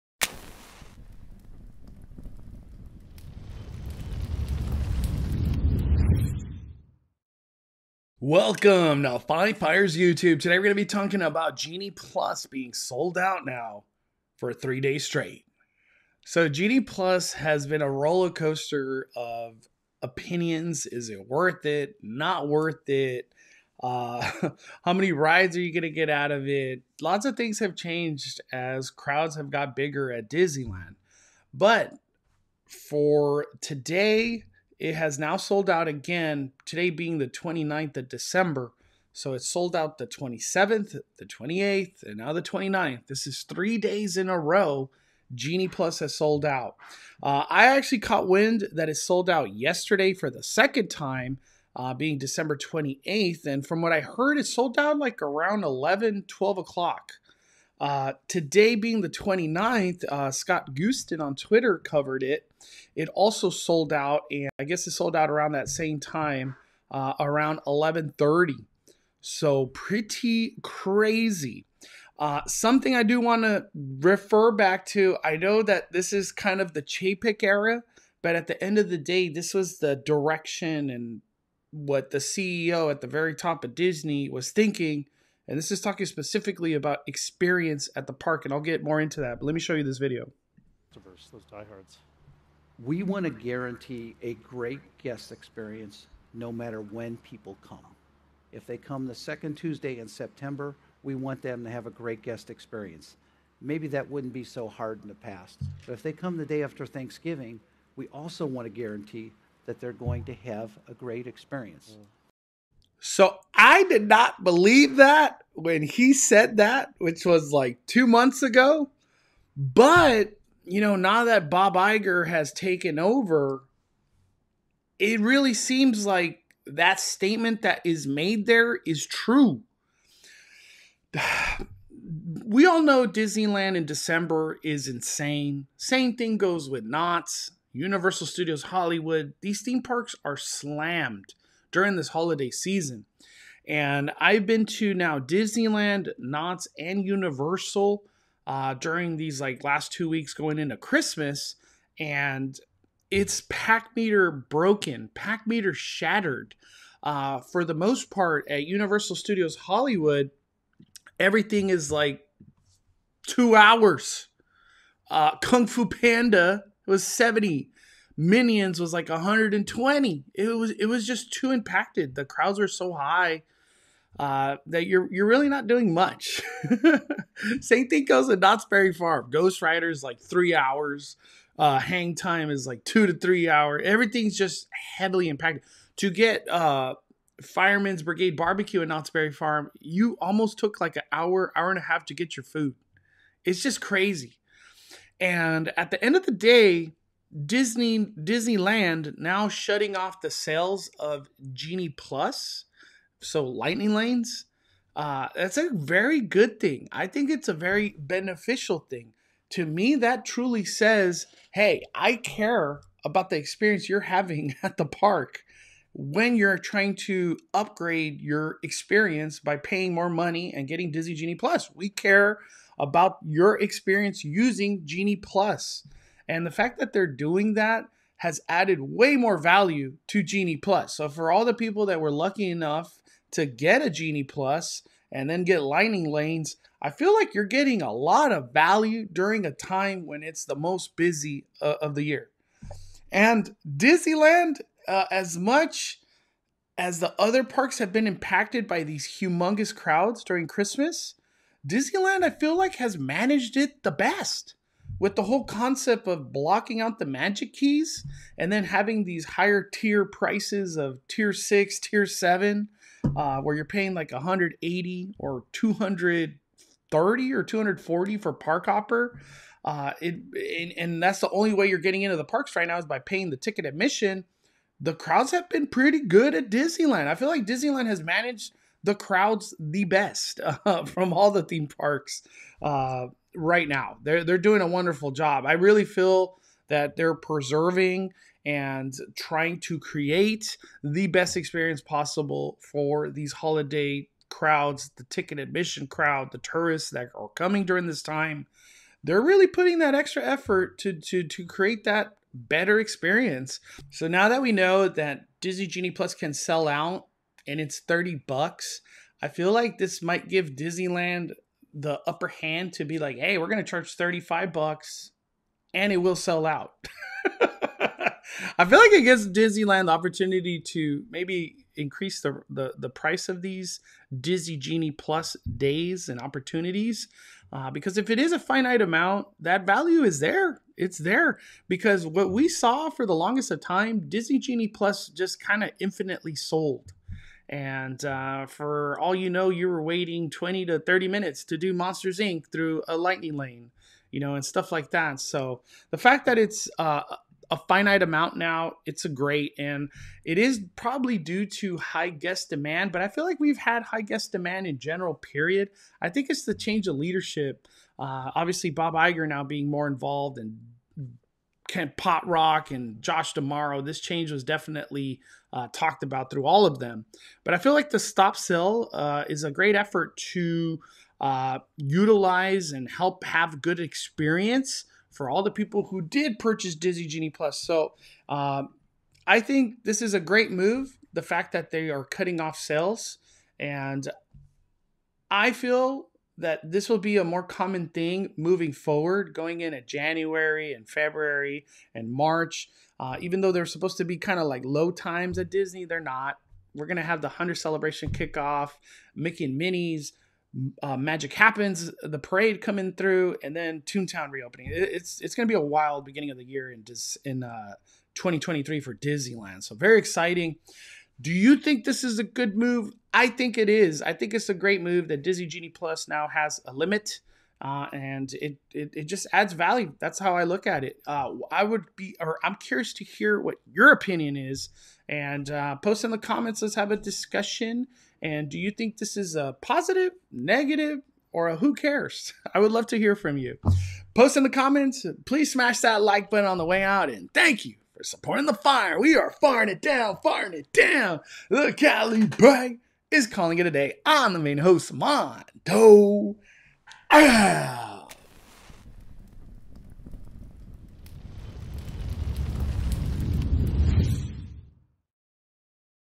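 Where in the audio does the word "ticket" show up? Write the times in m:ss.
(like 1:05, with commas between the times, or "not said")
4:33, 4:55.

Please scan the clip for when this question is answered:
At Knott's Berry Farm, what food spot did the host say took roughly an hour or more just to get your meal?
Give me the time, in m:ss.
3:07.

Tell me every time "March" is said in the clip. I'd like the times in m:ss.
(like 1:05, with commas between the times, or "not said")
6:32.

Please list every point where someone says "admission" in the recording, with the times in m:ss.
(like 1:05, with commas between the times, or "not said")
4:33, 4:55.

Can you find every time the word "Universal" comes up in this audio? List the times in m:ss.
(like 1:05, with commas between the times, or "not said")
2:17, 2:27, 2:38.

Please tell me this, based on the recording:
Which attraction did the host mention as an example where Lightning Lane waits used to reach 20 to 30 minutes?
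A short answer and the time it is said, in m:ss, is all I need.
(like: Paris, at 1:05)
Monsters Inc., at 5:41.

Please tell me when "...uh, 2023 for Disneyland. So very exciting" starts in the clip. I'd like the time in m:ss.
6:47.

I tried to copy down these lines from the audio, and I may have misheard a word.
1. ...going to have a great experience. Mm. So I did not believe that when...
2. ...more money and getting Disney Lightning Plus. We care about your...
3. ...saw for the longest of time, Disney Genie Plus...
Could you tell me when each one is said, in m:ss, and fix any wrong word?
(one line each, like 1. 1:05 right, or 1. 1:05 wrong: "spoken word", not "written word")
1. 1:49 right
2. 3:39 wrong: "Genie", not "Lightning"
3. 5:32 right.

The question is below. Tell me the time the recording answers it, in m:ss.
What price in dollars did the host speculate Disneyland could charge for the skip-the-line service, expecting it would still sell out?
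5:13.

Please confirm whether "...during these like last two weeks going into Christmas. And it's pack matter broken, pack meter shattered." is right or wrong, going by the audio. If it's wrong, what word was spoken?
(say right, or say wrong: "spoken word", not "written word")
wrong: "meter", not "matter".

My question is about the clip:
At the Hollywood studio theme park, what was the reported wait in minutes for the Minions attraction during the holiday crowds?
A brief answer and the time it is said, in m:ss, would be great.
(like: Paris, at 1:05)
120, at 2:49.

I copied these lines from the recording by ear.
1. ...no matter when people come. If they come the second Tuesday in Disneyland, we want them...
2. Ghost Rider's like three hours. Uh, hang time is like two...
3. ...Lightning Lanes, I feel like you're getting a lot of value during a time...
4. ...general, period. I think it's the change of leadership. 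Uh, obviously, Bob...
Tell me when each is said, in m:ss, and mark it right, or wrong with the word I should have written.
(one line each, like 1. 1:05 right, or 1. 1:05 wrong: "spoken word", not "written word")
1. 1:36 wrong: "September", not "Disneyland"
2. 2:59 right
3. 3:55 right
4. 5:54 right.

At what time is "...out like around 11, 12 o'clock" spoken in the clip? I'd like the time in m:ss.
0:54.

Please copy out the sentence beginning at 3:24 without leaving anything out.
Uh, that's a very good thing.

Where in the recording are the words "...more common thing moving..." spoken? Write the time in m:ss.
6:27.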